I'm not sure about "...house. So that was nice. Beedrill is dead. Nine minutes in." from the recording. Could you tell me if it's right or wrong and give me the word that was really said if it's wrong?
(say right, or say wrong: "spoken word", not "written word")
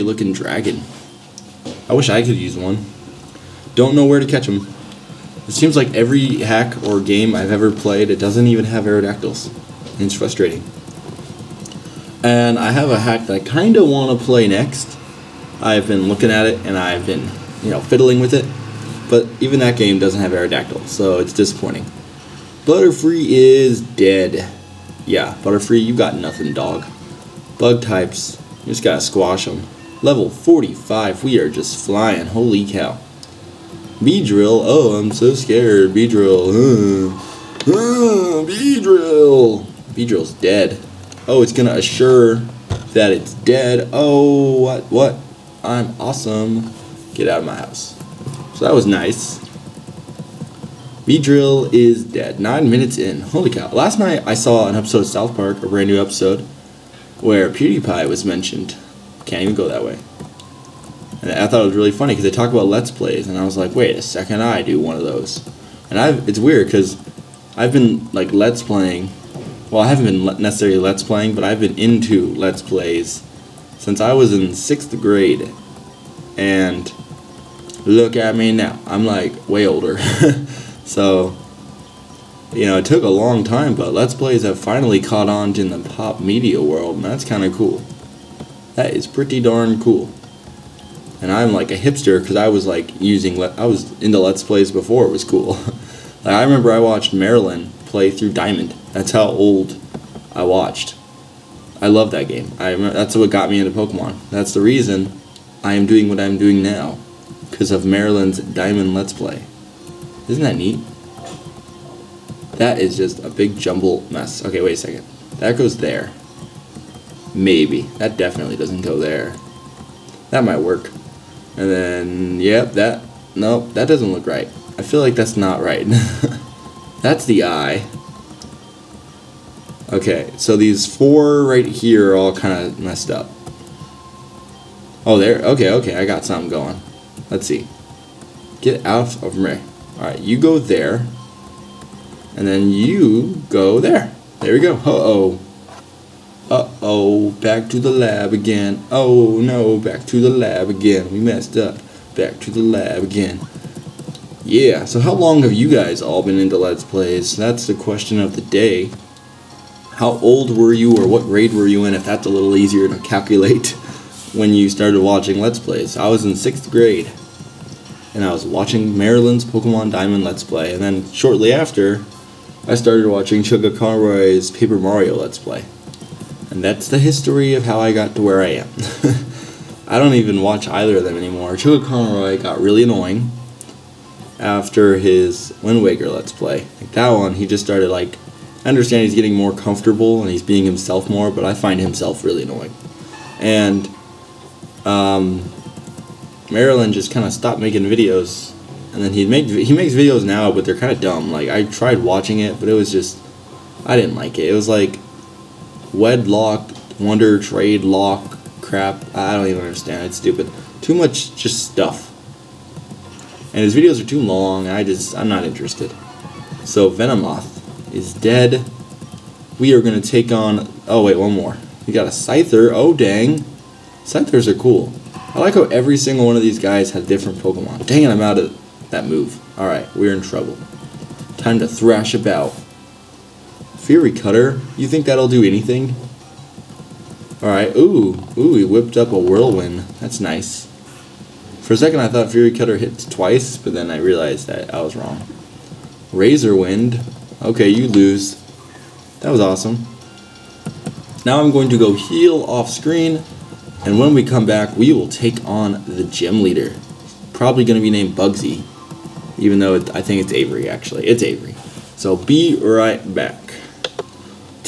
right.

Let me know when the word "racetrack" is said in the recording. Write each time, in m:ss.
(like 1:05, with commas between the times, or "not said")
not said.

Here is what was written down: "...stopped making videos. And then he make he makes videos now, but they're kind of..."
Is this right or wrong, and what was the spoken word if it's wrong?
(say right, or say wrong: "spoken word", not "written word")
right.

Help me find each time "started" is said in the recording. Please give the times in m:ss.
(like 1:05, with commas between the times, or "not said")
2:44, 2:52, 3:07.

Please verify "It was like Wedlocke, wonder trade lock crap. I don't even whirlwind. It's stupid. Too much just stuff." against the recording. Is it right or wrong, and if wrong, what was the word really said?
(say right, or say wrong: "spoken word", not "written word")
wrong: "understand", not "whirlwind".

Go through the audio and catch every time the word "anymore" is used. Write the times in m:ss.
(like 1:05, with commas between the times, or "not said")
3:01.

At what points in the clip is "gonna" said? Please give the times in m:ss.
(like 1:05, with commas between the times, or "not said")
0:41, 3:39.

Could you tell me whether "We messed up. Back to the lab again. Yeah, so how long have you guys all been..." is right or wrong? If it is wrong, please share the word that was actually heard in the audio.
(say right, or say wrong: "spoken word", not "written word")
right.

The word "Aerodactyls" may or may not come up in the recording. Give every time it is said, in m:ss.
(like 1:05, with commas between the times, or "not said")
0:08, 0:20.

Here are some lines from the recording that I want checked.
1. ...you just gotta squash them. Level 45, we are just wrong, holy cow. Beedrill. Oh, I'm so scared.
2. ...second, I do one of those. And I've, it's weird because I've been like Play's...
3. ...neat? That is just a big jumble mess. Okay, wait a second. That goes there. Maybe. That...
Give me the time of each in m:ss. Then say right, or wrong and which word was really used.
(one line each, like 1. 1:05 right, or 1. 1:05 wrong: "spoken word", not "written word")
1. 0:28 wrong: "flying", not "wrong"
2. 1:04 wrong: "Let", not "Play"
3. 1:50 right.